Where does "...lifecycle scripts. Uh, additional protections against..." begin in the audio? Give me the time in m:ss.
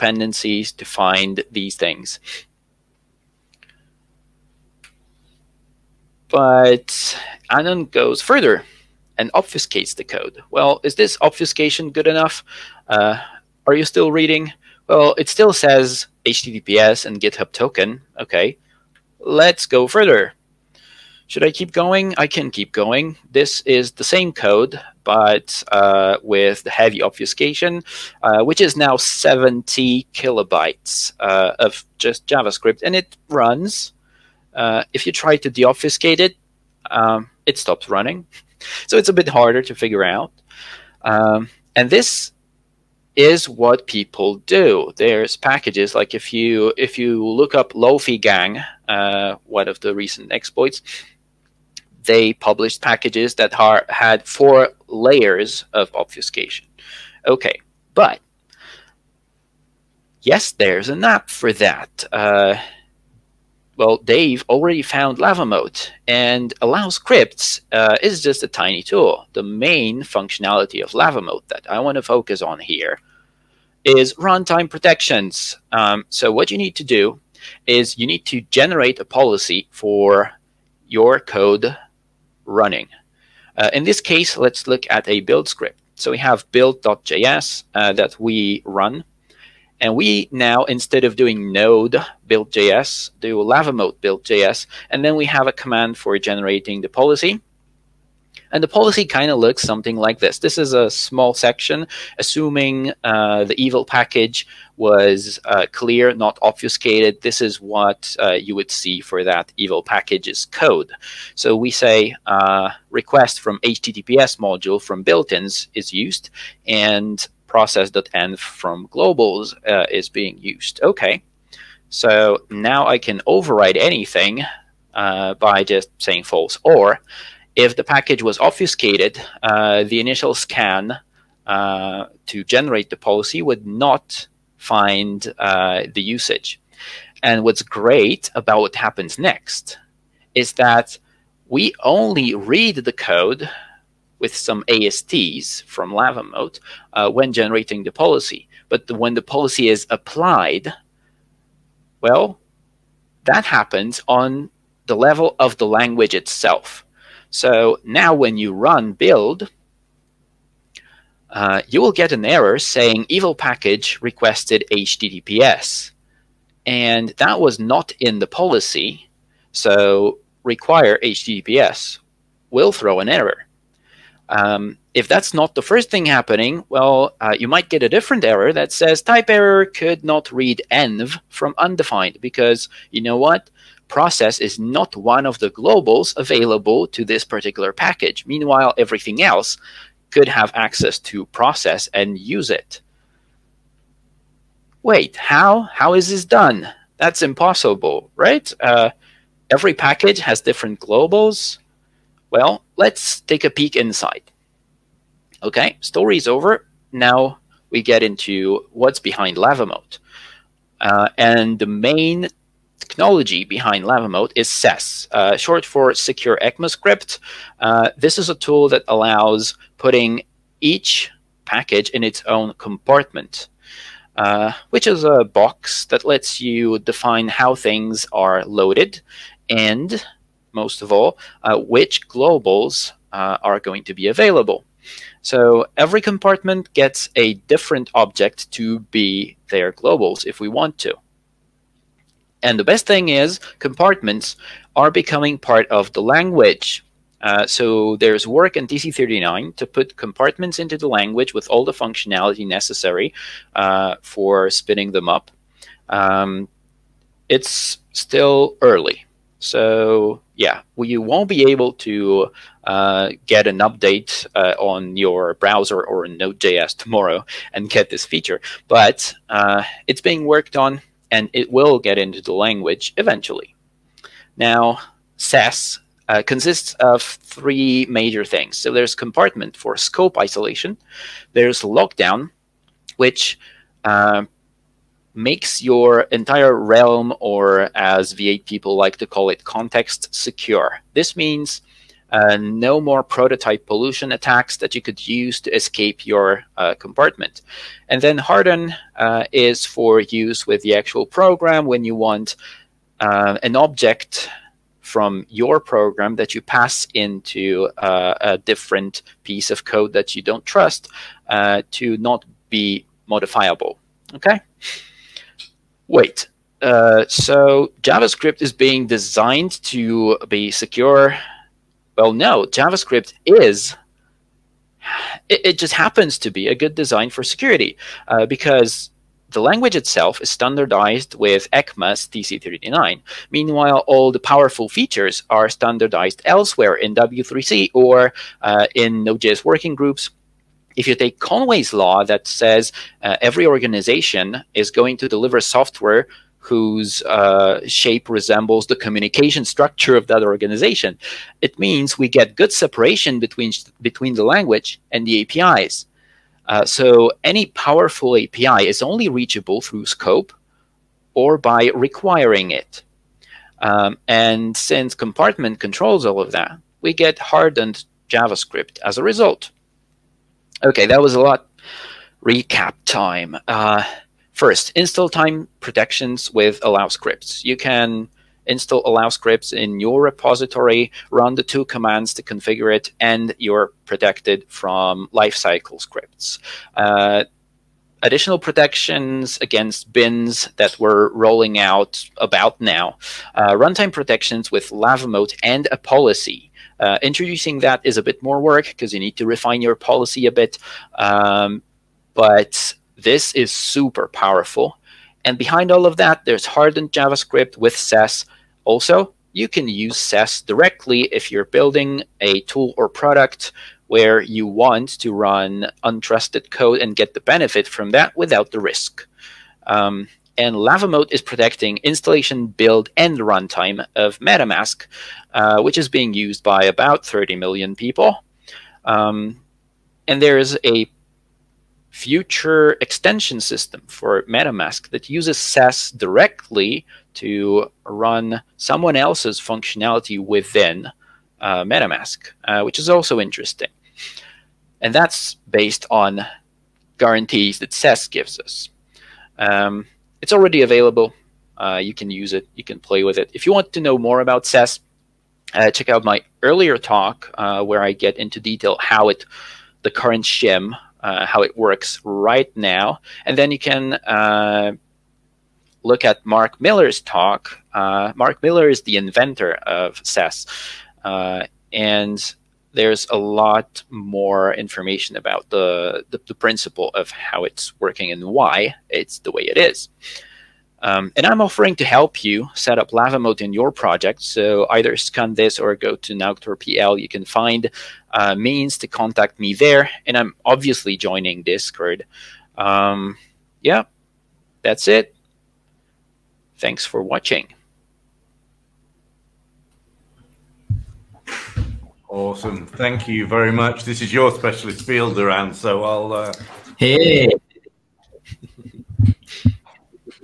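6:25.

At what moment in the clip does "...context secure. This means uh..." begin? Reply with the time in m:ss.
4:49.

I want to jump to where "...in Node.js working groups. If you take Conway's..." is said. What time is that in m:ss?
5:38.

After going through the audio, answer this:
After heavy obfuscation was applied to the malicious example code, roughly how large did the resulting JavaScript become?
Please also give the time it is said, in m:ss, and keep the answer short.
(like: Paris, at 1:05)
70 kilobytes, at 0:28.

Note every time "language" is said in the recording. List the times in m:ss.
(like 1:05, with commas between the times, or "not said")
2:35, 4:06, 4:10, 4:32, 5:29, 5:54.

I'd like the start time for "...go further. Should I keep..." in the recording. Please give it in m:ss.
0:19.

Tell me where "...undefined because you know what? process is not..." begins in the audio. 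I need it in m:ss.
3:01.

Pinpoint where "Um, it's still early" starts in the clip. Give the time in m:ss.
4:15.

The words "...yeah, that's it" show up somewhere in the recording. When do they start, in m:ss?
8:13.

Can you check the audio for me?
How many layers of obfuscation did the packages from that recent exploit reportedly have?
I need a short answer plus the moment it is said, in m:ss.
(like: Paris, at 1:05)
4, at 0:54.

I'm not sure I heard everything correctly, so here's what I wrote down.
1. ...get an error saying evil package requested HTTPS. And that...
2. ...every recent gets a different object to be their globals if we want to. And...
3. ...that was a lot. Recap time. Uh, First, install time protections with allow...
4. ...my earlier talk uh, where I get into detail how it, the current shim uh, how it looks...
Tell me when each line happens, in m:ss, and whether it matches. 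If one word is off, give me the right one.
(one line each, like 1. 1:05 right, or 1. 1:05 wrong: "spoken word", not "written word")
1. 2:41 right
2. 3:55 wrong: "compartment", not "recent"
3. 6:10 right
4. 7:36 wrong: "works", not "looks".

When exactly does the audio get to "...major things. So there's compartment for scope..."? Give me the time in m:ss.
4:37.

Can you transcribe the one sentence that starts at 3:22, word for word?
Well, let's take a peek inside.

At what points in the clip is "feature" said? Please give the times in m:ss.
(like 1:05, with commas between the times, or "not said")
4:28, 5:34.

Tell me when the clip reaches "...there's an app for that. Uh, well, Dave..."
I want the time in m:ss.
1:00.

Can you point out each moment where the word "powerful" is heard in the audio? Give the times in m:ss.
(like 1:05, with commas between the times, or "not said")
5:34, 5:57, 6:44.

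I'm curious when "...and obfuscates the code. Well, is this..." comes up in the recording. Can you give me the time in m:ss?
0:09.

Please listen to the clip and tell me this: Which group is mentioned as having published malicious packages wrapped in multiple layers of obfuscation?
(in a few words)
LofyGang.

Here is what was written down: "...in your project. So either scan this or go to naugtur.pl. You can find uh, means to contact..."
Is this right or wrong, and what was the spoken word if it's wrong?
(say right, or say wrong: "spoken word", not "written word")
right.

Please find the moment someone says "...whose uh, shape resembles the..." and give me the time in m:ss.
5:46.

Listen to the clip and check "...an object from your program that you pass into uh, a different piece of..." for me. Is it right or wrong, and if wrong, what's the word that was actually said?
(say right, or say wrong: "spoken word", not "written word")
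right.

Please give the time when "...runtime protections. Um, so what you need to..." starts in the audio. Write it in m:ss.
1:14.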